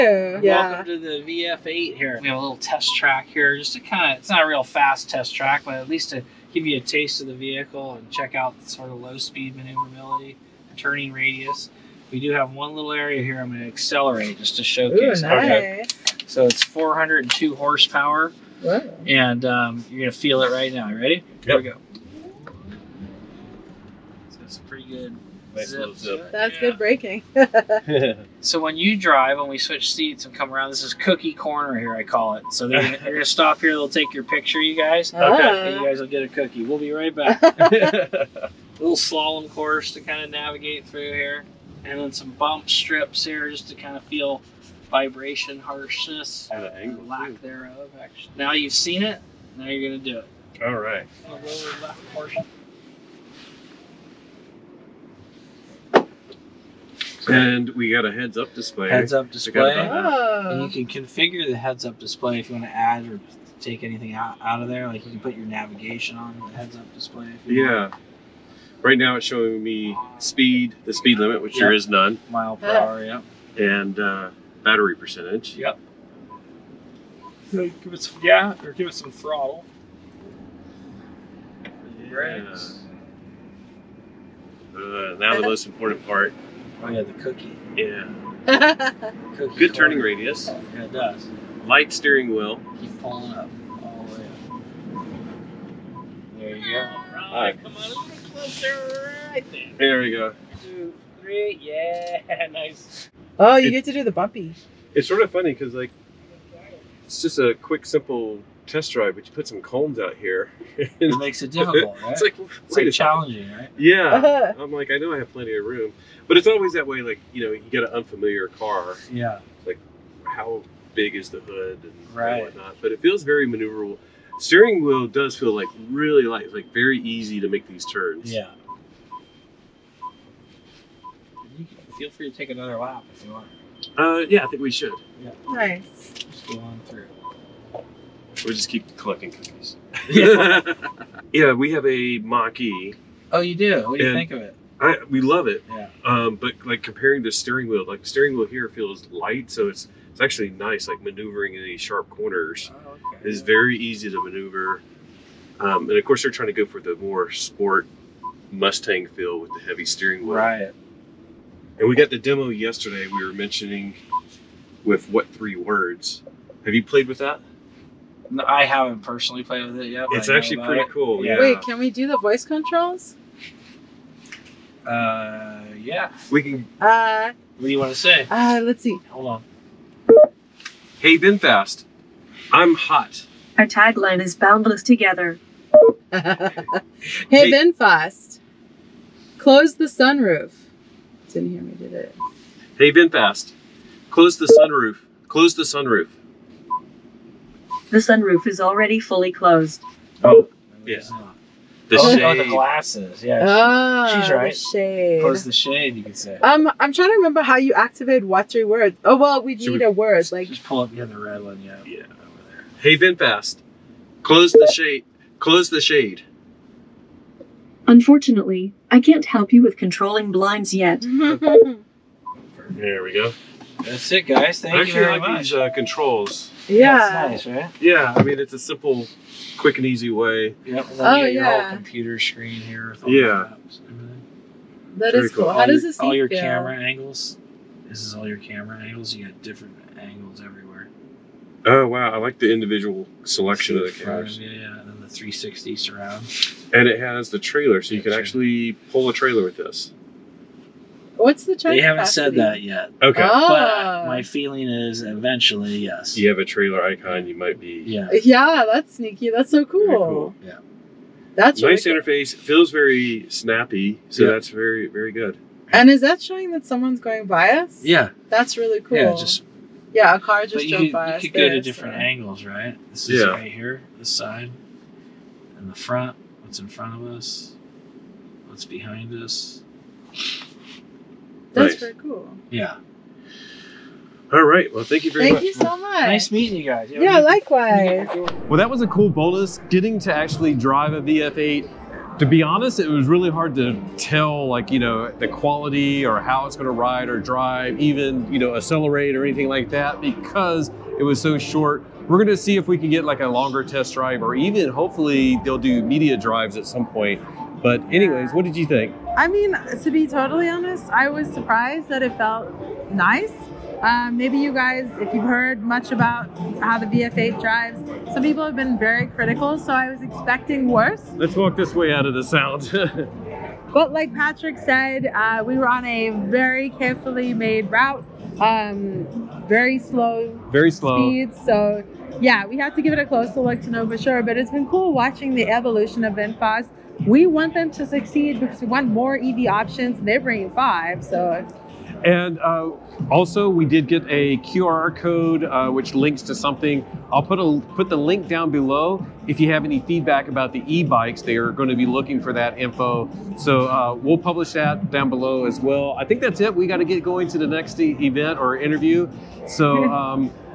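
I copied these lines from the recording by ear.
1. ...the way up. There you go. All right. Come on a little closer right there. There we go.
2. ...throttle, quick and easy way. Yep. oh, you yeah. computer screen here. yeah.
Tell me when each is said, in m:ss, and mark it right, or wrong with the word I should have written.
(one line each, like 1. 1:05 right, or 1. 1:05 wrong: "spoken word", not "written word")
1. 1:34 right
2. 3:48 wrong: "simple", not "throttle".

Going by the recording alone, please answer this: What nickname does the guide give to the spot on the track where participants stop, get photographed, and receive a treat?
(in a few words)
cookie corner.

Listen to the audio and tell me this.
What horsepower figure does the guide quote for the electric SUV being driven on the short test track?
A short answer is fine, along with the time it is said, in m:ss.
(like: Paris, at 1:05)
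402, at 0:16.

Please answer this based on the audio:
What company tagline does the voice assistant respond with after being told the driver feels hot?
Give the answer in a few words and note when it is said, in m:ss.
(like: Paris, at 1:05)
Boundless together, at 3:04.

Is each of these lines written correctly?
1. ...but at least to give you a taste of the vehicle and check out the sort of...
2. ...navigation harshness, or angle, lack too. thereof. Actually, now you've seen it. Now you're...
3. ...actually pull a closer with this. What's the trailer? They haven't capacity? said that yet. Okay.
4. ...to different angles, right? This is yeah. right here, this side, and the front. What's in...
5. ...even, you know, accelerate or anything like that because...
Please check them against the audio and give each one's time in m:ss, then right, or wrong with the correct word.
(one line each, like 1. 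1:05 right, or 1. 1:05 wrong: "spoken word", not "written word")
1. 0:05 right
2. 0:44 wrong: "vibration", not "navigation"
3. 4:08 wrong: "trailer", not "closer"
4. 4:31 right
5. 4:57 right.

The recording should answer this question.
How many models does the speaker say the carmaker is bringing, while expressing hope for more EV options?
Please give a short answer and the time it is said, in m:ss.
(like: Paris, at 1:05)
5, at 5:40.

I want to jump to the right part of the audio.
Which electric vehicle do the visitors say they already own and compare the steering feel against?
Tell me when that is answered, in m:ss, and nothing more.
2:22.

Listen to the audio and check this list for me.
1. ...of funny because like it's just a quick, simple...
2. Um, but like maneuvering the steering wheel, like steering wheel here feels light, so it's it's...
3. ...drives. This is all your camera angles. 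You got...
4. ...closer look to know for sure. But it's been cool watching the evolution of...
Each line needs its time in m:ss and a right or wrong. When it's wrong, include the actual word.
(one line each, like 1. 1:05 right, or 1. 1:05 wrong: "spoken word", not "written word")
1. 1:45 right
2. 2:26 wrong: "comparing", not "maneuvering"
3. 3:56 wrong: "angles", not "drives"
4. 5:33 right.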